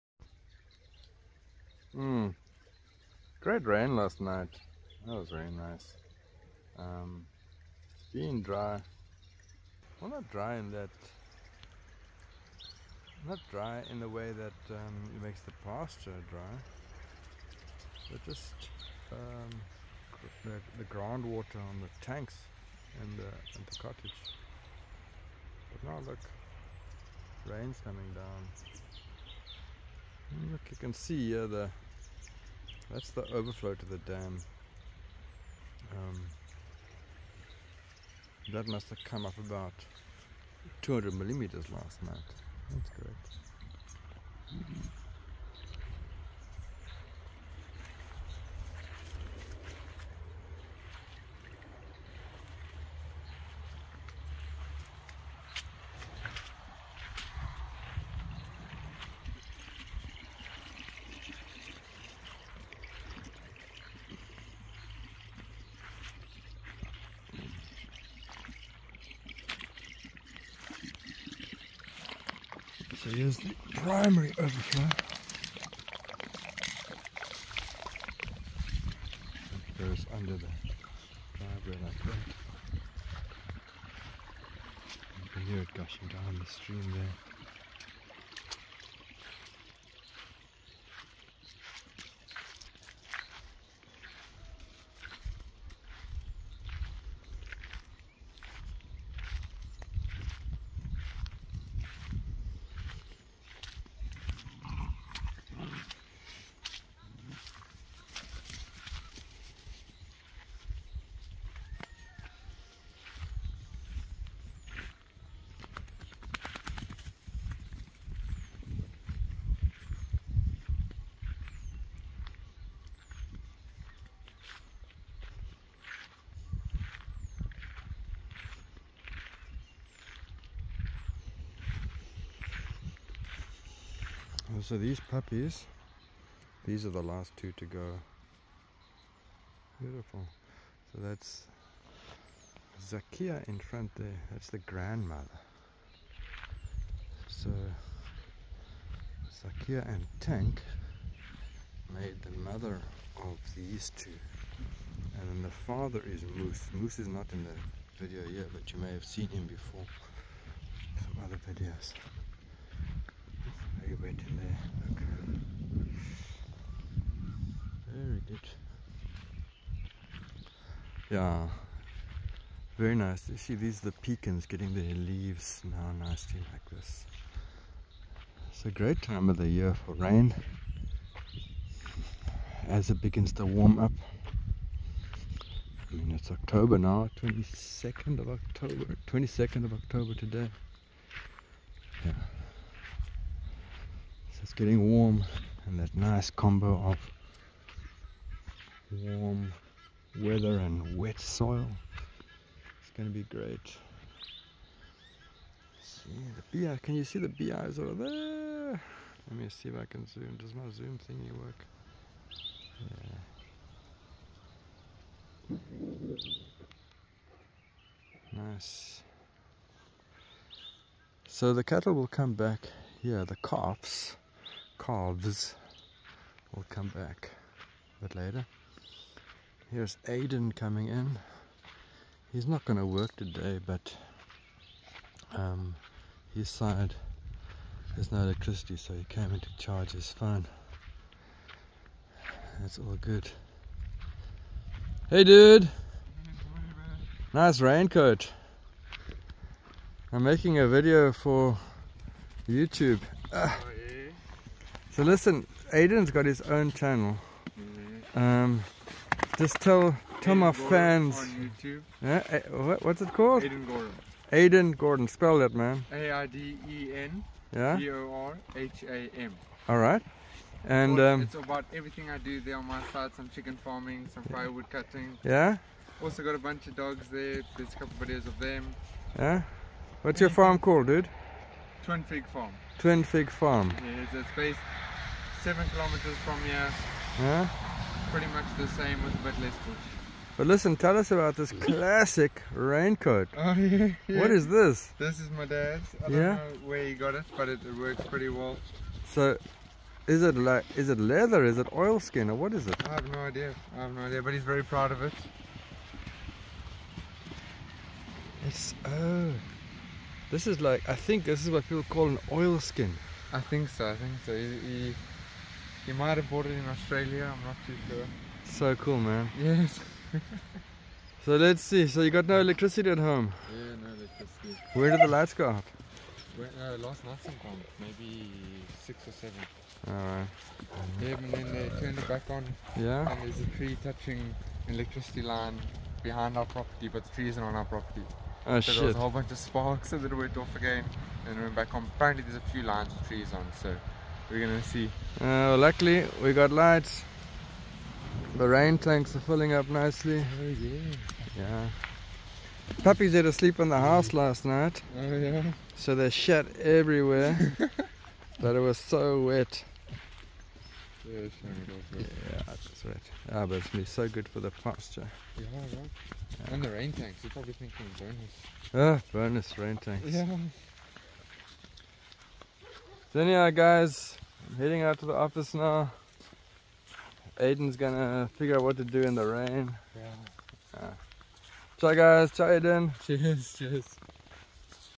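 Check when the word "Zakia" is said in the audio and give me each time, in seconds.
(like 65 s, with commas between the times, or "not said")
142 s, 149 s.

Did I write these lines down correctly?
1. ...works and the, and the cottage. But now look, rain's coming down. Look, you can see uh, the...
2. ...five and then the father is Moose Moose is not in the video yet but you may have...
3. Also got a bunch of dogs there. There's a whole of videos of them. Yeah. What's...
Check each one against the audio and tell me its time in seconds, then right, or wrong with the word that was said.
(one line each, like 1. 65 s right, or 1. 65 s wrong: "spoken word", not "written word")
1. 22 s wrong: "tanks", not "works"
2. 153 s wrong: "two", not "five"
3. 276 s wrong: "couple", not "whole".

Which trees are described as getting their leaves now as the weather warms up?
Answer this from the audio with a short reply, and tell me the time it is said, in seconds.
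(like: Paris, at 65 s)
Pecans, at 173 s.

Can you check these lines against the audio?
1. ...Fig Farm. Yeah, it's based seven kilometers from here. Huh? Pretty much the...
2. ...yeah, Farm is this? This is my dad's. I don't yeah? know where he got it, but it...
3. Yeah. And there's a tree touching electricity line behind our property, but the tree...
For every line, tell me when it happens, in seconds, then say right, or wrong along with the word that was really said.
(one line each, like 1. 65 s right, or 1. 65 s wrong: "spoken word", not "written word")
1. 283 s right
2. 294 s wrong: "What", not "Farm"
3. 332 s right.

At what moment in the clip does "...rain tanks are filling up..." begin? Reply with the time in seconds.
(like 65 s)
348 s.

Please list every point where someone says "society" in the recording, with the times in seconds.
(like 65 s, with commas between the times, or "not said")
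not said.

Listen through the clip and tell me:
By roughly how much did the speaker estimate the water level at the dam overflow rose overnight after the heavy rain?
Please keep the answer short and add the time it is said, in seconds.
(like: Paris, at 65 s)
200 millimeters, at 40 s.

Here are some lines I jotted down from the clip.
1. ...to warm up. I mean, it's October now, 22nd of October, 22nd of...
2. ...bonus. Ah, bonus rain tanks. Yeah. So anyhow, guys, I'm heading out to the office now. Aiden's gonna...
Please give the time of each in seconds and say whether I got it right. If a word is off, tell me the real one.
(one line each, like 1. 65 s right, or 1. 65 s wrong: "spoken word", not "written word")
1. 183 s right
2. 367 s right.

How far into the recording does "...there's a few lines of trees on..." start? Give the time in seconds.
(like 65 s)
342 s.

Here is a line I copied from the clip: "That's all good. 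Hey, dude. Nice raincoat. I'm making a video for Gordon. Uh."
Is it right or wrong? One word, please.
wrong.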